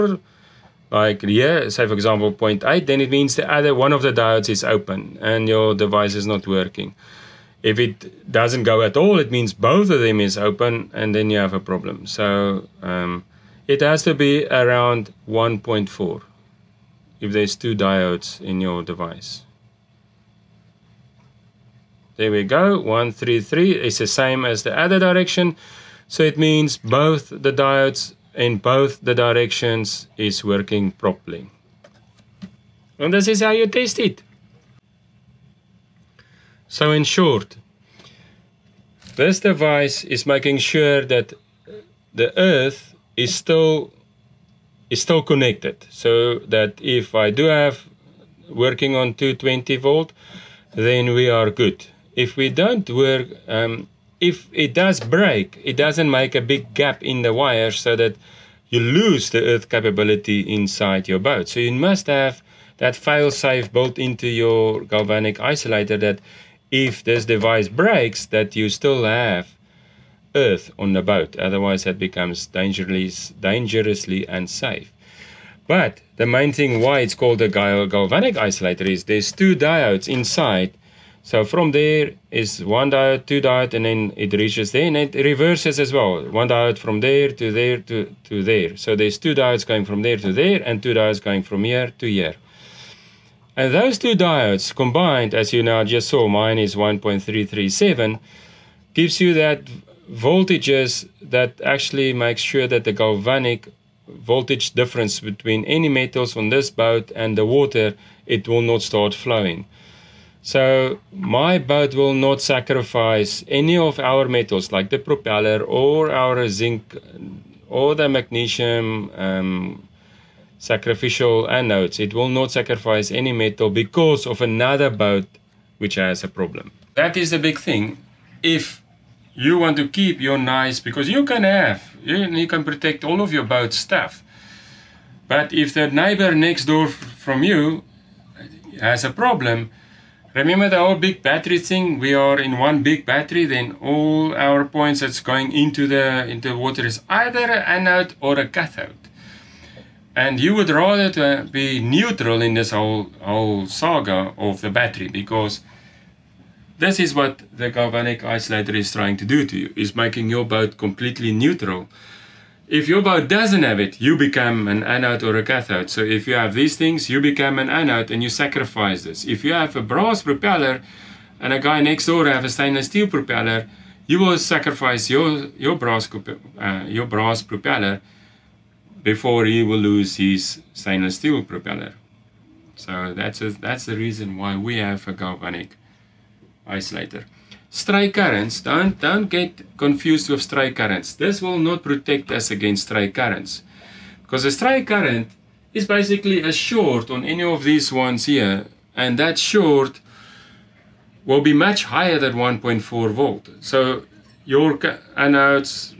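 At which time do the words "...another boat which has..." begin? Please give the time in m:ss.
2:04.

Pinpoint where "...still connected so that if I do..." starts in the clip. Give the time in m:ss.
0:45.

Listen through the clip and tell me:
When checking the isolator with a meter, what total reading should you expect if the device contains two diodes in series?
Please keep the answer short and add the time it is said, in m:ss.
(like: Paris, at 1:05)
around 1.4, at 0:14.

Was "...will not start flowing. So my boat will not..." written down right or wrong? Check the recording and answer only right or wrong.
right.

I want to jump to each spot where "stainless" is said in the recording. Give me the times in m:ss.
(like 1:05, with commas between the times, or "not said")
2:52, 3:00.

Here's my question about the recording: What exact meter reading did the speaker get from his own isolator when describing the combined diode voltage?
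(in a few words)
1.337.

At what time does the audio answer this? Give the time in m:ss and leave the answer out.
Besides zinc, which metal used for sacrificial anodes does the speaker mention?
1:58.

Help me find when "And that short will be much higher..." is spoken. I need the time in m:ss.
3:18.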